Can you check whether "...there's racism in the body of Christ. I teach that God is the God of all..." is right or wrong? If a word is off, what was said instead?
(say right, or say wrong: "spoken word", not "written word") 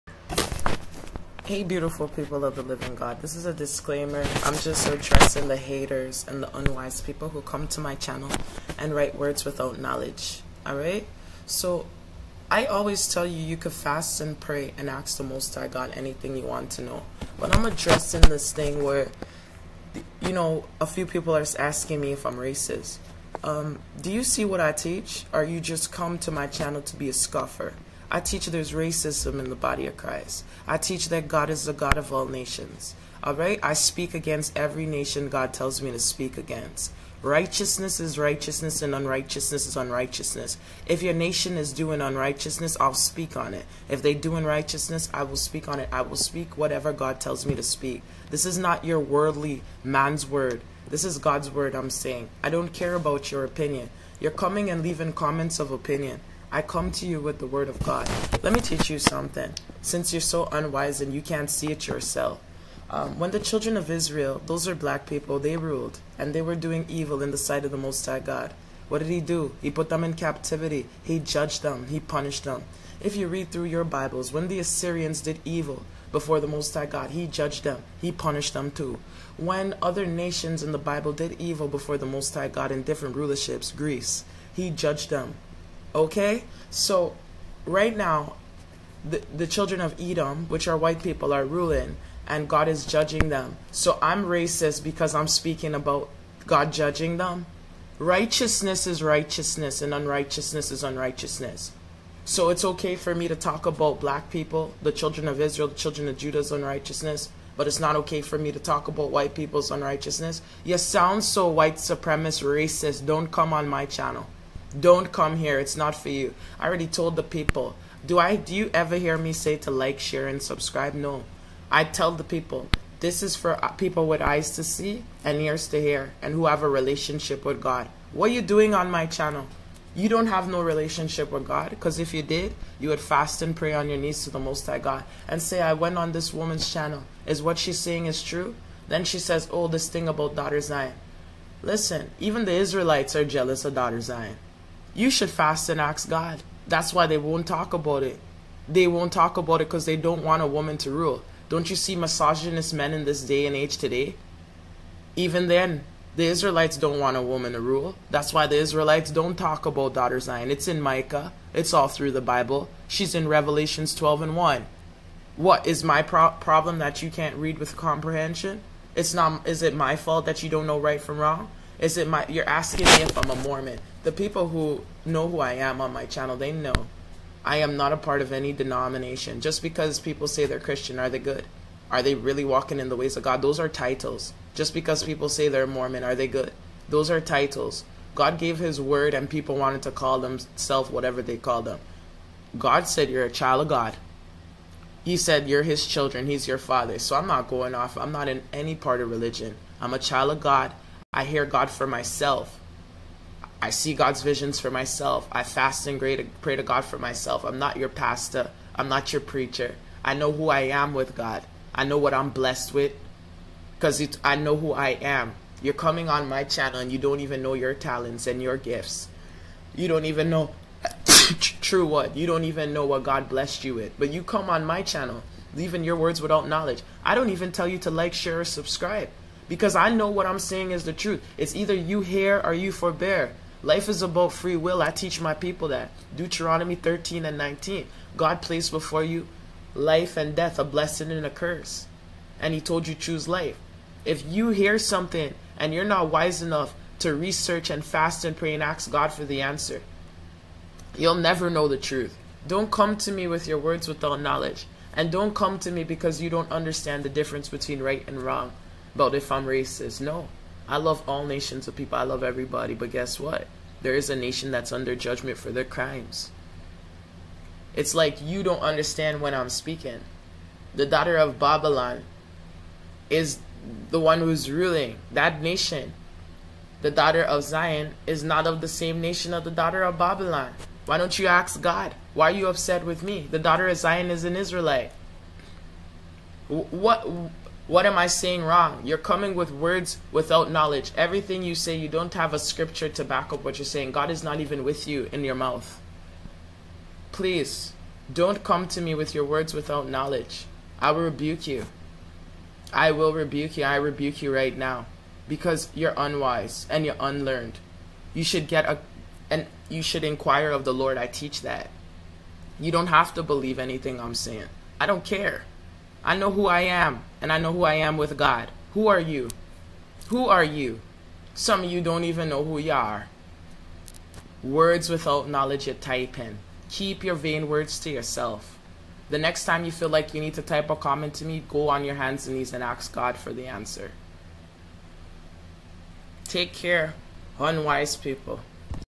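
right.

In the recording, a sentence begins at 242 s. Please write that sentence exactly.
And he told you choose life.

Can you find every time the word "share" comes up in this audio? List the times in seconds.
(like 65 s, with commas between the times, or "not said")
119 s, 228 s.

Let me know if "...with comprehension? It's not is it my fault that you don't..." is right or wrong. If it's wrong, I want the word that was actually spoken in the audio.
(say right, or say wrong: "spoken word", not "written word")
right.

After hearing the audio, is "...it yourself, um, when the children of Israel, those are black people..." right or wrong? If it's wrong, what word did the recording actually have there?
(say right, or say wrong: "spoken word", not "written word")
right.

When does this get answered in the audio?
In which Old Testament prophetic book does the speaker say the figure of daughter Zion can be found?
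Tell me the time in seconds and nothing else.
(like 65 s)
160 s.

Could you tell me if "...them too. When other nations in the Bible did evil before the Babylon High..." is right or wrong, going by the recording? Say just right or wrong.
wrong.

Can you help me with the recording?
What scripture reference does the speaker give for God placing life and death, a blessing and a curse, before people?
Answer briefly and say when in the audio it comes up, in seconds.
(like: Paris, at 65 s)
Deuteronomy 13:19, at 236 s.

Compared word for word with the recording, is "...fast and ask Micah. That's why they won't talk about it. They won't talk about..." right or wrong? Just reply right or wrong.
wrong.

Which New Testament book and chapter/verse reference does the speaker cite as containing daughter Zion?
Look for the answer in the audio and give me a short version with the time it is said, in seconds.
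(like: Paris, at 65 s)
Revelation 12:1, at 163 s.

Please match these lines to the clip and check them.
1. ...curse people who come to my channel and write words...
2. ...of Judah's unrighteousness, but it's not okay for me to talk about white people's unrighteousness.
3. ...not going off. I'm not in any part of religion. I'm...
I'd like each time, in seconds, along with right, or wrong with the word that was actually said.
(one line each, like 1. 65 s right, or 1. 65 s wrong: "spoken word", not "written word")
1. 6 s wrong: "unwise", not "curse"
2. 106 s right
3. 197 s right.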